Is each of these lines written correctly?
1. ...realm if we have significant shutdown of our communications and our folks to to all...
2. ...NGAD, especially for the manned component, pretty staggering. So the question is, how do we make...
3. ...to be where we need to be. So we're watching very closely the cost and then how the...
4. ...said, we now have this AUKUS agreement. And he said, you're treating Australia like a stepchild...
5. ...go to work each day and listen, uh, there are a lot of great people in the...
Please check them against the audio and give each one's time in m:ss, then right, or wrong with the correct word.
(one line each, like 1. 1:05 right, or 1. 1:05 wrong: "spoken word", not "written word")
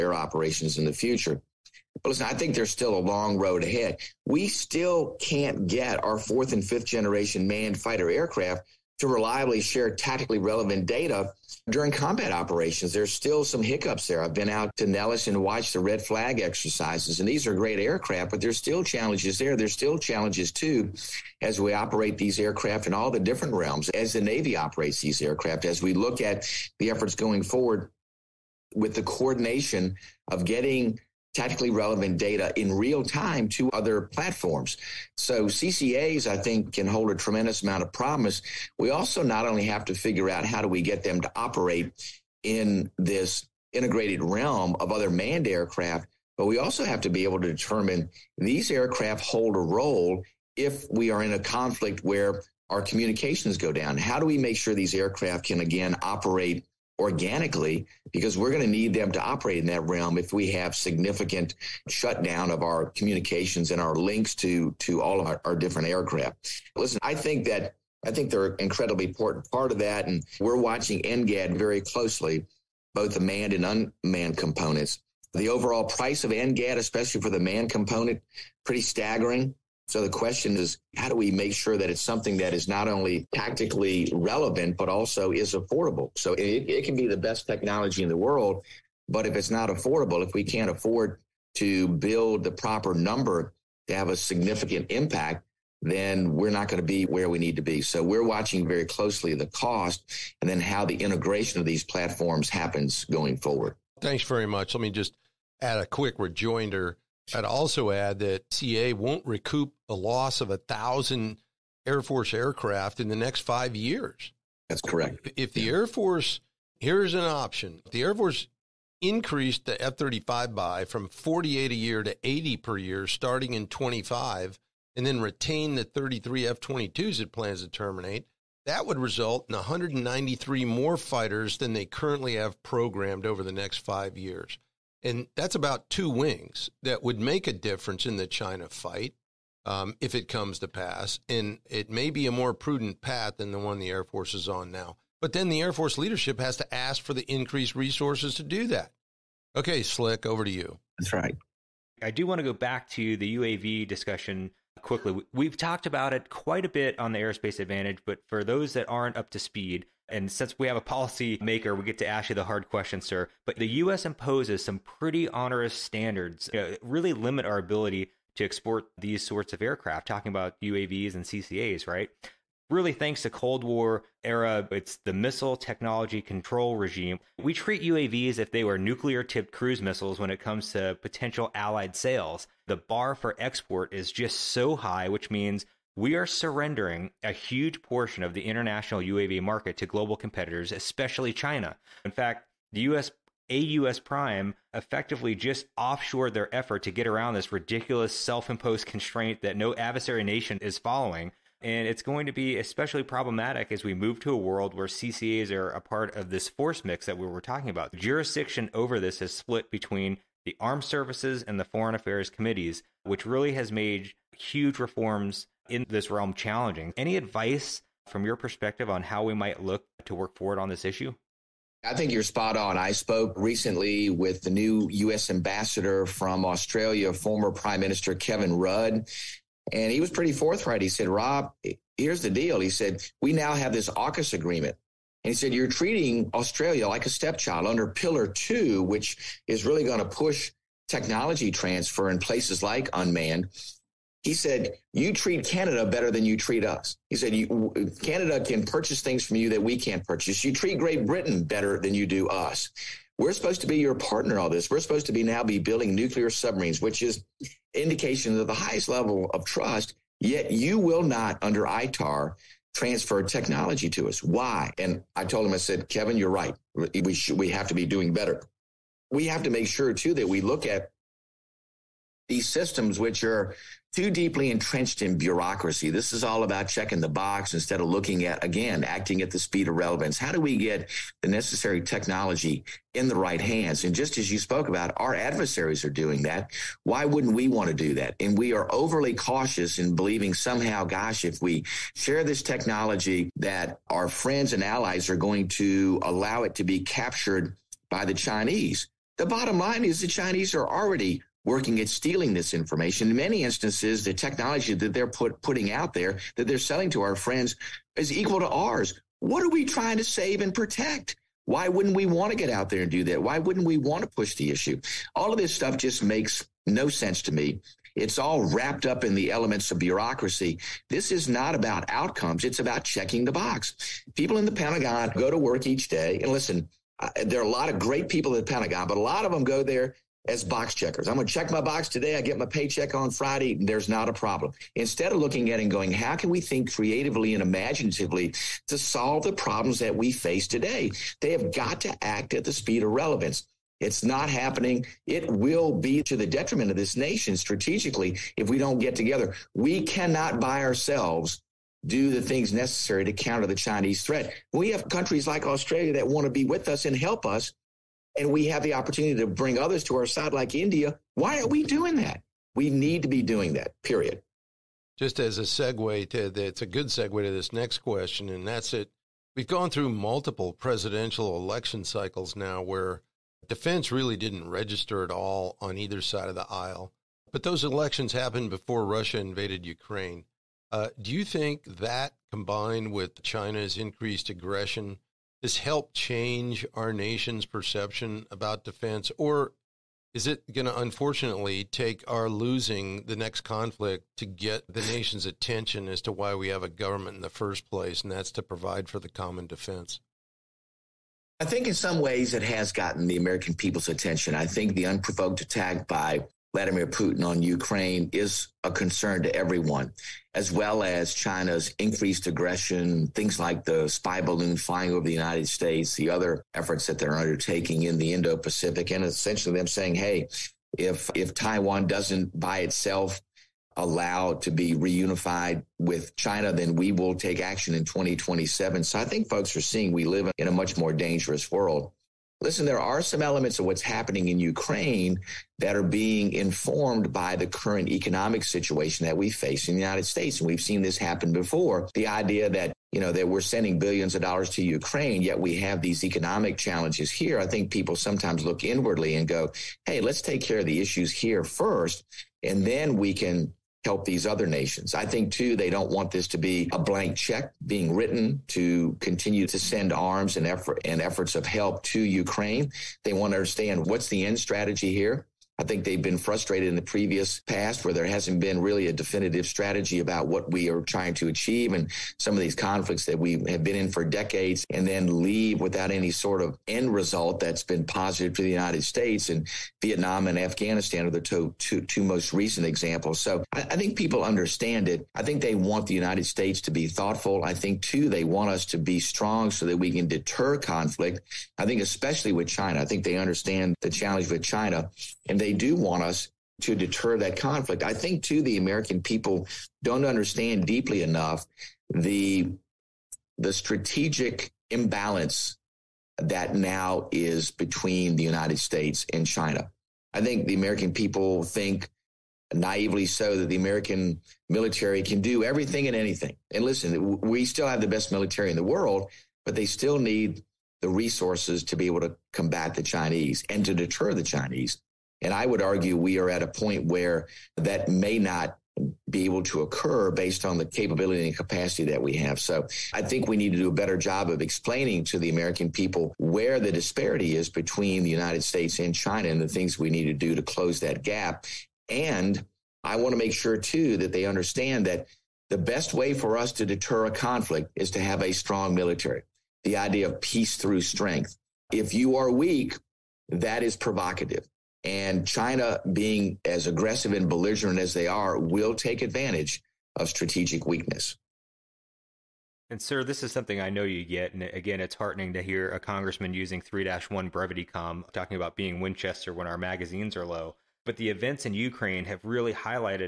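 1. 0:59 wrong: "links", not "folks"
2. 1:16 right
3. 1:36 right
4. 3:52 right
5. 5:25 right.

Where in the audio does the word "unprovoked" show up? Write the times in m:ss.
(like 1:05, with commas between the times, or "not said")
6:44.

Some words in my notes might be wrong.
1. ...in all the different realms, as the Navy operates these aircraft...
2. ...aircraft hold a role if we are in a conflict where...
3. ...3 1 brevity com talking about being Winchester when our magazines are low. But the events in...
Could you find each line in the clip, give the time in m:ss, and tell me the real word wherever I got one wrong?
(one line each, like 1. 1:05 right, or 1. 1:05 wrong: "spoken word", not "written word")
1. 0:22 right
2. 0:48 right
3. 9:26 right.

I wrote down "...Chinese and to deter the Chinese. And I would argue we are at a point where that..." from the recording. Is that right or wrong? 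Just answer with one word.
right.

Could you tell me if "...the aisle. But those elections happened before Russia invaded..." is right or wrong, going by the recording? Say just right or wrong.
right.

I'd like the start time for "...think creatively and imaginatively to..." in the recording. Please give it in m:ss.
5:36.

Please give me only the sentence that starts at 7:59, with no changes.
And Vietnam and Afghanistan are the two, two, two most recent examples.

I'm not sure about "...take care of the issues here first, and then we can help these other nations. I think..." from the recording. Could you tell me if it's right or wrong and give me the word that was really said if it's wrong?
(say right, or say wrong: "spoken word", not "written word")
right.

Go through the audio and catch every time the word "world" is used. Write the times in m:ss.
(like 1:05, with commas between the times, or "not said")
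1:28, 3:24, 7:11, 8:38.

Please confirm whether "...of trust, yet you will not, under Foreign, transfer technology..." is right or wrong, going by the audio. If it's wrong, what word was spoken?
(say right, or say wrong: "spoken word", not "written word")
wrong: "ITAR", not "Foreign".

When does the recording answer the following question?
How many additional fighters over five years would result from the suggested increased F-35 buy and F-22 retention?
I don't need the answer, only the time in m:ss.
2:09.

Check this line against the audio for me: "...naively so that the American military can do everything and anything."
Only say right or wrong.
right.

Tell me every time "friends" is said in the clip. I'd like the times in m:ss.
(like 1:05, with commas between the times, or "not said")
4:54, 5:07.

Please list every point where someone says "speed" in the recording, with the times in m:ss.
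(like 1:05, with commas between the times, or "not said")
2:39, 4:39, 5:42.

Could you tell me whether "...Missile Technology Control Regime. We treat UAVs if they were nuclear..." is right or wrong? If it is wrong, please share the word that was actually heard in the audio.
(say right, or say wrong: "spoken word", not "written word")
right.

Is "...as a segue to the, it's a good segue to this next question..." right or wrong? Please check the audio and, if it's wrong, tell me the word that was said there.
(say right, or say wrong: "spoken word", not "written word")
right.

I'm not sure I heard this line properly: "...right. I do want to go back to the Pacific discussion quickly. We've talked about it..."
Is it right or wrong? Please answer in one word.
wrong.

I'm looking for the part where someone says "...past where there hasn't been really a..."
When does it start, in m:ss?
7:47.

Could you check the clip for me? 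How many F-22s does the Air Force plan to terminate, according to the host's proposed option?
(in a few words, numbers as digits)
33.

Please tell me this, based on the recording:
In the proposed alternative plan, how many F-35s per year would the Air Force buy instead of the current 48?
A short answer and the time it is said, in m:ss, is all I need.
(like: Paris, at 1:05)
80, at 2:02.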